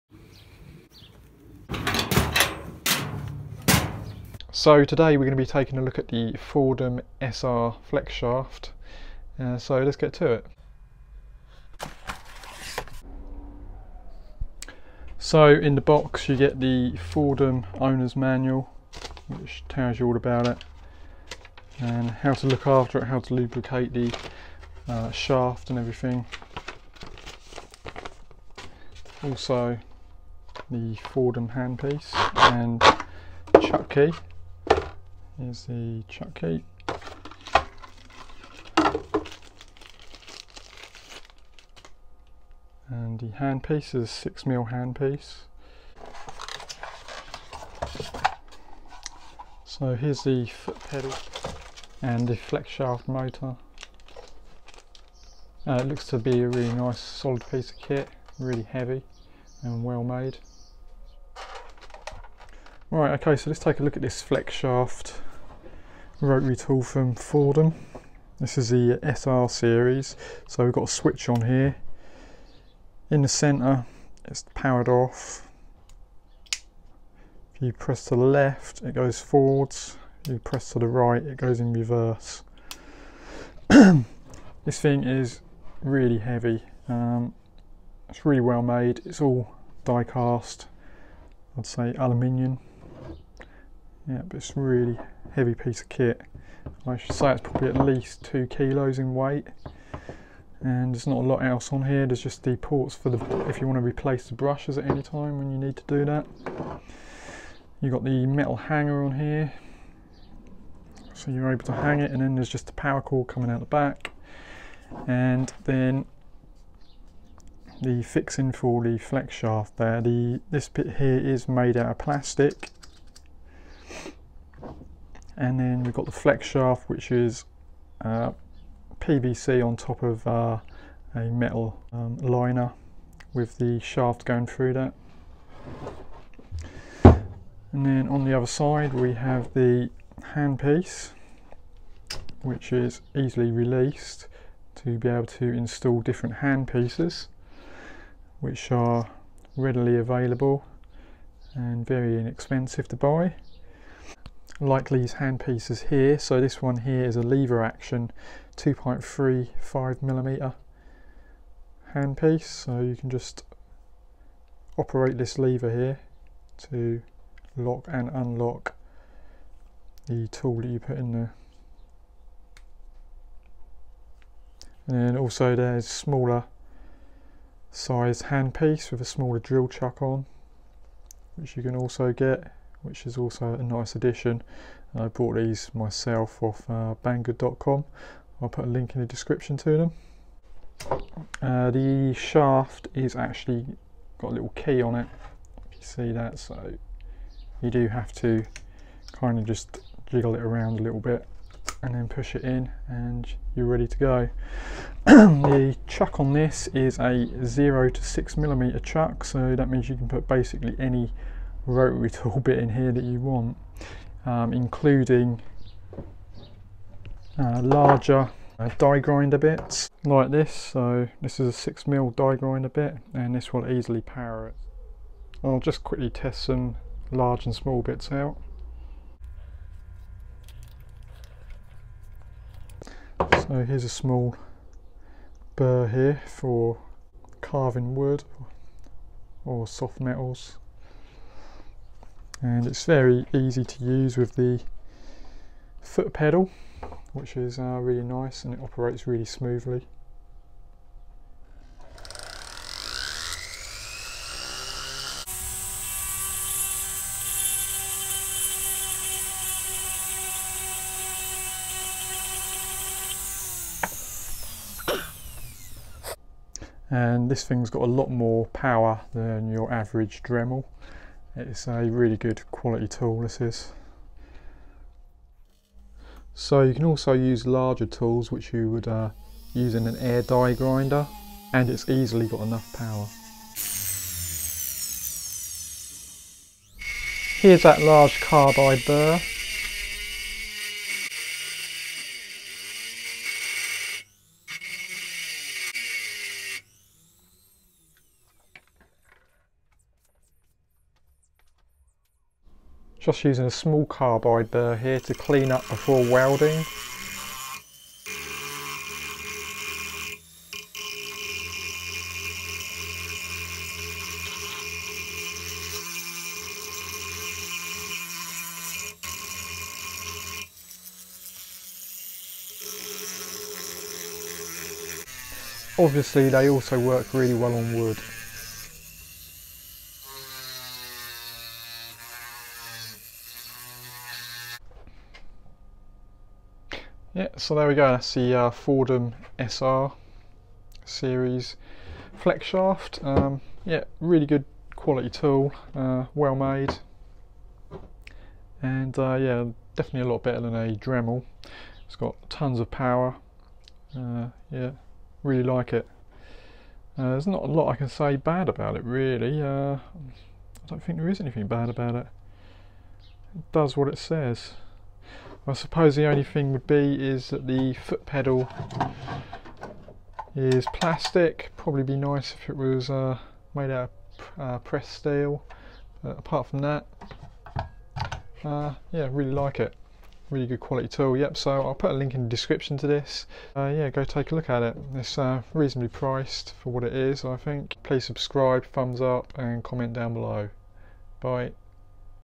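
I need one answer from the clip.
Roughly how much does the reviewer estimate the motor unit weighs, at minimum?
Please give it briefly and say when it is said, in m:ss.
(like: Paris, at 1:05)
2 kilos, at 1:38.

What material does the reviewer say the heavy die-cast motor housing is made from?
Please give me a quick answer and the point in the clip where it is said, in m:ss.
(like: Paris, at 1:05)
Aluminium, at 1:31.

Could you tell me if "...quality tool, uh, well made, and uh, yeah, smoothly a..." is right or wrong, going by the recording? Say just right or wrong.
wrong.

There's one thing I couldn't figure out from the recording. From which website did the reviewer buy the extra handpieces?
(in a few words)
Banggood.com.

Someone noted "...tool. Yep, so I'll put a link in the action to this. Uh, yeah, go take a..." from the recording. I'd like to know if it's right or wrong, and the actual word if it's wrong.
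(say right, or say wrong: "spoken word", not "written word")
wrong: "description", not "action".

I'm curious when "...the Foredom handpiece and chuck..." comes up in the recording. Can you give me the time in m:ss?
0:30.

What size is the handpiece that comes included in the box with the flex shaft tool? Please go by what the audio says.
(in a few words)
6mm.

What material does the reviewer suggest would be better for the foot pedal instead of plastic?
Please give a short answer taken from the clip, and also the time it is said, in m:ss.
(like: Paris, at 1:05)
Pressed steel, at 6:14.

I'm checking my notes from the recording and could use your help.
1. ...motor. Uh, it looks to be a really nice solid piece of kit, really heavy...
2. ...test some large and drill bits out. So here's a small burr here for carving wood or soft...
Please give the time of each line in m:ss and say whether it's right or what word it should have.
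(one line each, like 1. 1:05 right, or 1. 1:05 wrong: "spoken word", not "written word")
1. 0:53 right
2. 3:46 wrong: "small", not "drill".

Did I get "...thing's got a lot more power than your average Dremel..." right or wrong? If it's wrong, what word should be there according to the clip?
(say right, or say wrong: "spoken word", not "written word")
right.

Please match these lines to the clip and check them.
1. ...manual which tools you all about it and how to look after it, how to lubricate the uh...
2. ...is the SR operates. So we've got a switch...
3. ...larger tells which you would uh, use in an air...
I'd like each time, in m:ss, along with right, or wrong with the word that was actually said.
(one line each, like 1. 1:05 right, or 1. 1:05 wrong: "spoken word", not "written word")
1. 0:18 wrong: "tells", not "tools"
2. 1:08 wrong: "series", not "operates"
3. 4:37 wrong: "tools", not "tells".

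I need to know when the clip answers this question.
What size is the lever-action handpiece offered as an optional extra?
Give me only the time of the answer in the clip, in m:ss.
2:38.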